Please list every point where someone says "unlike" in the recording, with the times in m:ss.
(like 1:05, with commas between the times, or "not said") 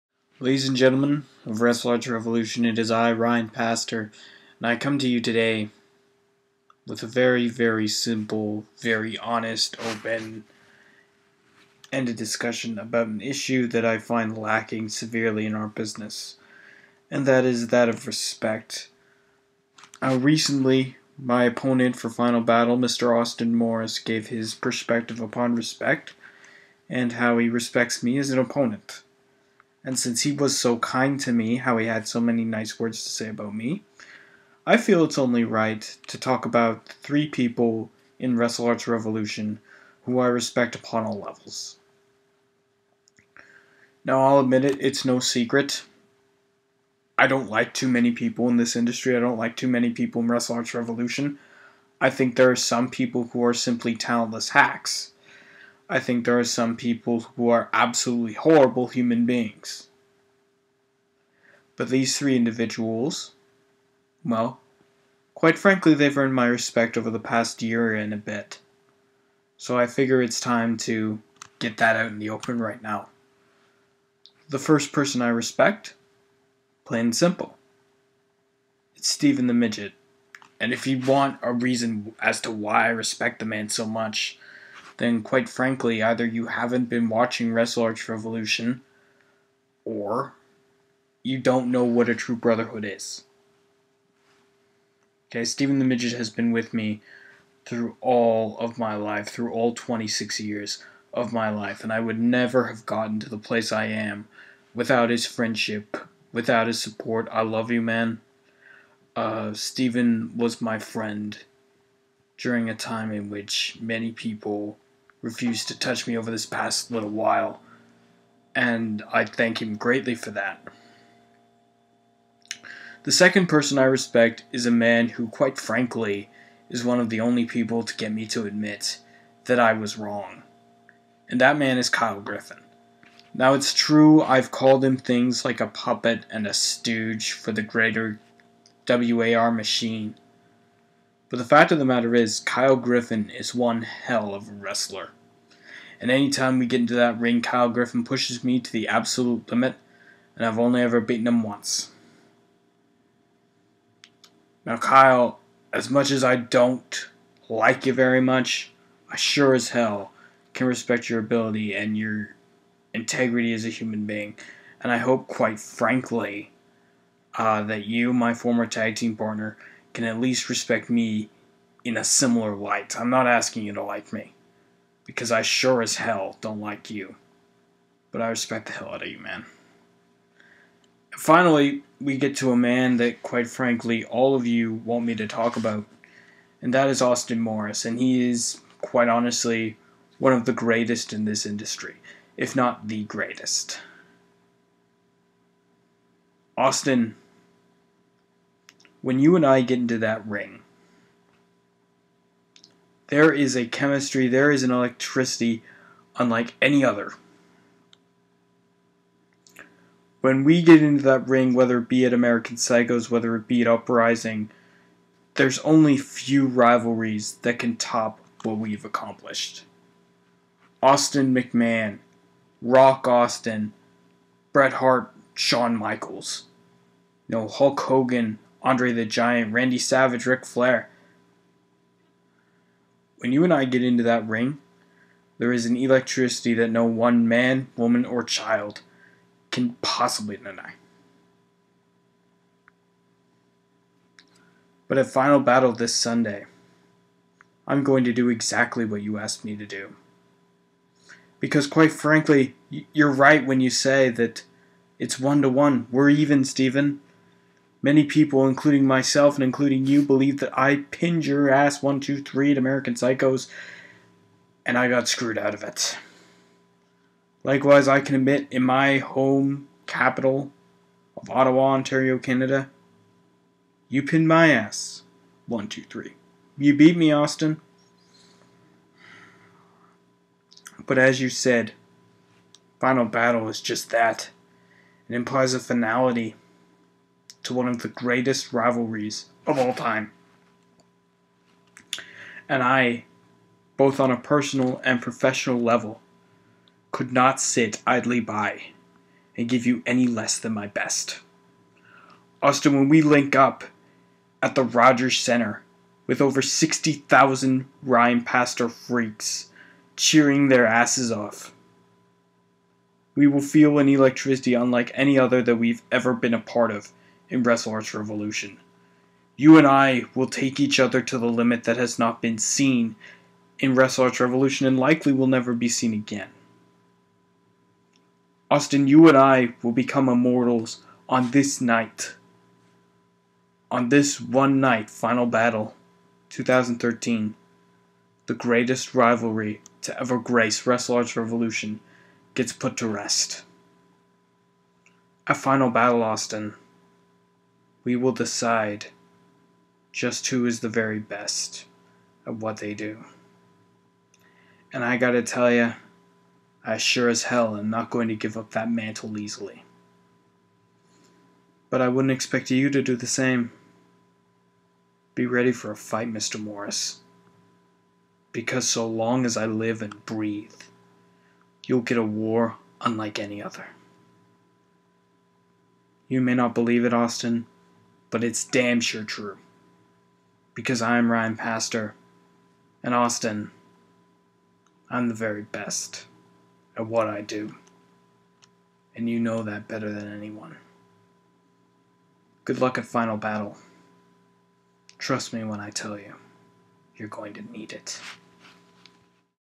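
3:26, 5:14, 6:12.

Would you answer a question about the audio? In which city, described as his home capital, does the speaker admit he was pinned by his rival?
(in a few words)
Ottawa.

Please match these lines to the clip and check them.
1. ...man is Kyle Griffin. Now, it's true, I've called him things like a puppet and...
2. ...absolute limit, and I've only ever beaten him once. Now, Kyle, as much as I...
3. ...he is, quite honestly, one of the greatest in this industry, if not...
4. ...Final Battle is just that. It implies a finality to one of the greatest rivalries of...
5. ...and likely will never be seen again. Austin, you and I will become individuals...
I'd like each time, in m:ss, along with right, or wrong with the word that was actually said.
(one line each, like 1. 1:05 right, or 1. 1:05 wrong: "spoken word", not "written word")
1. 2:11 right
2. 2:28 right
3. 3:07 right
4. 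4:42 right
5. 5:24 wrong: "immortals", not "individuals".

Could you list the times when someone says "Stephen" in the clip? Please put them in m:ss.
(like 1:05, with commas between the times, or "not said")
1:19, 1:35, 1:49, 4:16.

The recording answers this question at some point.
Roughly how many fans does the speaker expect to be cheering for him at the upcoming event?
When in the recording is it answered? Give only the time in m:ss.
5:06.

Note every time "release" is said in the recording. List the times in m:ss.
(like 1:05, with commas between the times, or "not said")
not said.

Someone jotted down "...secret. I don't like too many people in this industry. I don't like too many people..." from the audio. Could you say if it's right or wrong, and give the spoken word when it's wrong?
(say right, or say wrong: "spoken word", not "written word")
right.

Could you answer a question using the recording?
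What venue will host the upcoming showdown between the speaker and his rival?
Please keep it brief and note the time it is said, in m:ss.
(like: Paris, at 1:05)
Rogers Center, at 5:04.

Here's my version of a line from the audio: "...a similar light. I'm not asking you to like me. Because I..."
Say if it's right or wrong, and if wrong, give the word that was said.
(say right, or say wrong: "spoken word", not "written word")
right.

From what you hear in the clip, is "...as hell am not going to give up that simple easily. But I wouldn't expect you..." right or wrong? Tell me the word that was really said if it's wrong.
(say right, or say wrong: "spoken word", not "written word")
wrong: "mantle", not "simple".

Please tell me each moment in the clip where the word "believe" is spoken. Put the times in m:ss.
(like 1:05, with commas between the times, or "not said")
4:20, 6:16.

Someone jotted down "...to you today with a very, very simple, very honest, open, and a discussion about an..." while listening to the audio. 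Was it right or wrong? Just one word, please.
right.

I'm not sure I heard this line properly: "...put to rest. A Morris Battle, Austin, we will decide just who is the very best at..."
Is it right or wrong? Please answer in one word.
wrong.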